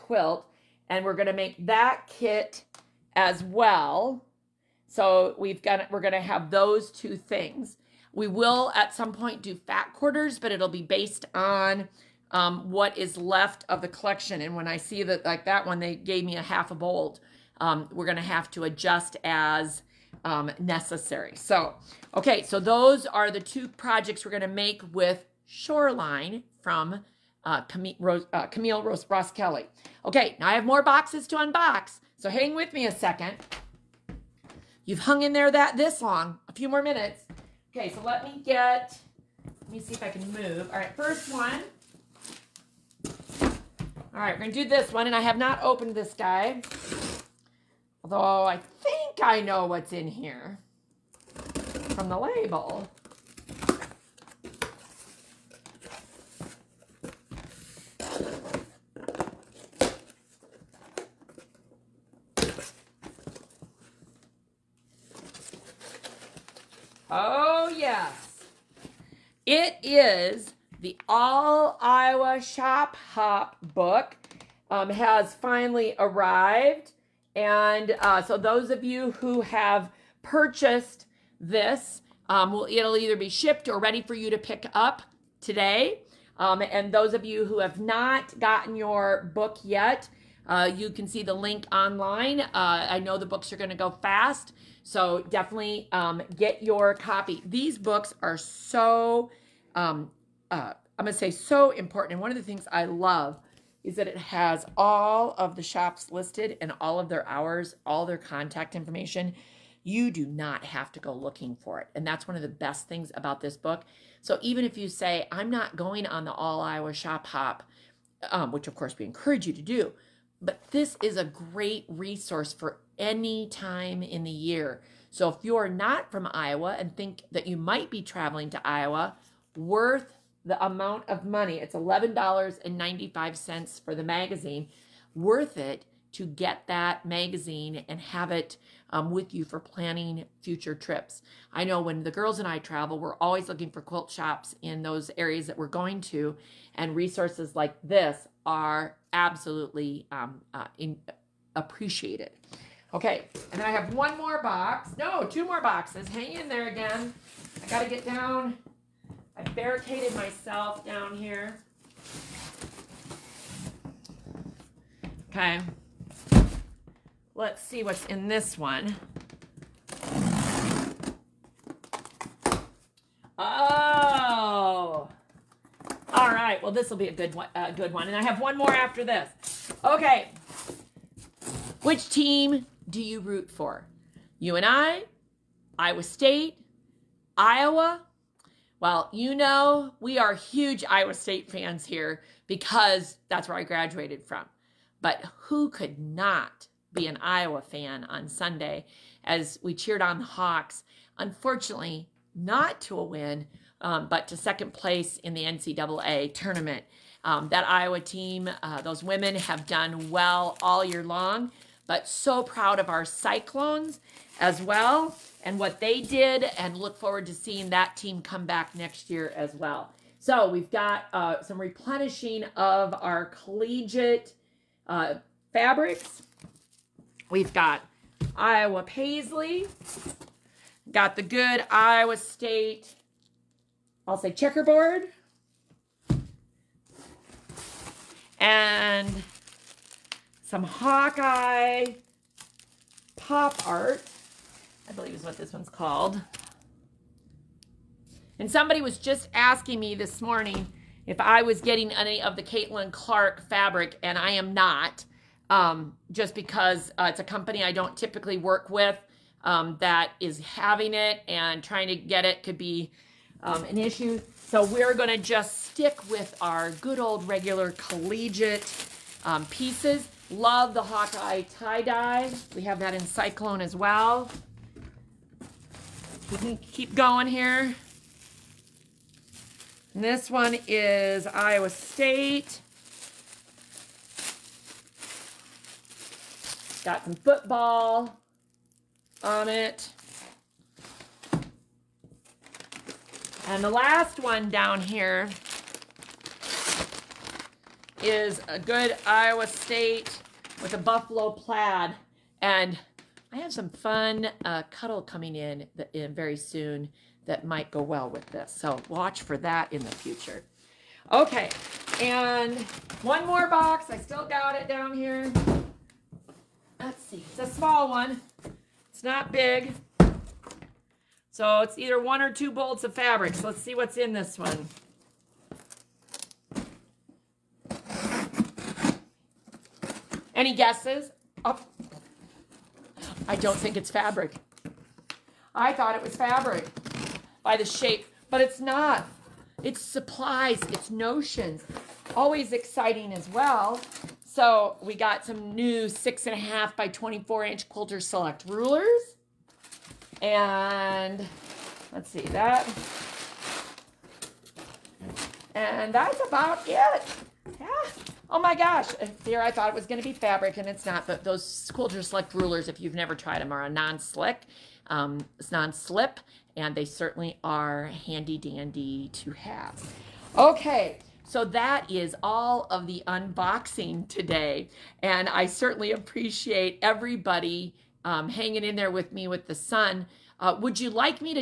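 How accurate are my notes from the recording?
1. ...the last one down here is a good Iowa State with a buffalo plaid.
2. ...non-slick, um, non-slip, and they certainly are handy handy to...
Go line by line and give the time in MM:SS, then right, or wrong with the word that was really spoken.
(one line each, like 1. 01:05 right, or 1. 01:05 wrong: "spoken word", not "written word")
1. 04:53 right
2. 06:03 wrong: "dandy", not "handy".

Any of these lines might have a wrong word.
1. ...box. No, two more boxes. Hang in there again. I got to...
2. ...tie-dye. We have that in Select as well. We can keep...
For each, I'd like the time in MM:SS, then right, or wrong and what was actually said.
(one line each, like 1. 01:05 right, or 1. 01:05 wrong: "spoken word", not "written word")
1. 02:34 right
2. 04:31 wrong: "Cyclone", not "Select".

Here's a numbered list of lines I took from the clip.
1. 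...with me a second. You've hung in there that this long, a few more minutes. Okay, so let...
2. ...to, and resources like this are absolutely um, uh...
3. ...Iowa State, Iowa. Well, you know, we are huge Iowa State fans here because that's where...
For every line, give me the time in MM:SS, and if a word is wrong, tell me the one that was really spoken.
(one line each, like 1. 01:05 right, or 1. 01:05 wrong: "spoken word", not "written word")
1. 00:32 right
2. 02:26 right
3. 03:05 right.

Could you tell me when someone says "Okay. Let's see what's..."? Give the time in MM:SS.
02:45.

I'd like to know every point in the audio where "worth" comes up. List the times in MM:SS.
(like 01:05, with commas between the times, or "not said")
02:09, 02:15.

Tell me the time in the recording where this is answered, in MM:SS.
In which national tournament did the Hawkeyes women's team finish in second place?
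03:25.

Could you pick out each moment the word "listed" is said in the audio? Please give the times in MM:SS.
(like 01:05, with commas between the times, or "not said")
01:46.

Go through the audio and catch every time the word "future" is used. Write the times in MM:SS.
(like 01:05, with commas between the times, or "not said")
02:20, 05:09.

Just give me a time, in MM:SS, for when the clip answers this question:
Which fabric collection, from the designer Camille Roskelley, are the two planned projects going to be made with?
00:25.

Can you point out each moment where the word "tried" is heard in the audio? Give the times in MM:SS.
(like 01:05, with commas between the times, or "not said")
06:03.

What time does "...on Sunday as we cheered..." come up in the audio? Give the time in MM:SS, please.
03:18.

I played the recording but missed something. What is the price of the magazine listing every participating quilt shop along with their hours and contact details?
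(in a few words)
$11.95.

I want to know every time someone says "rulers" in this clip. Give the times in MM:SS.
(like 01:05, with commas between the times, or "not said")
05:48, 06:02.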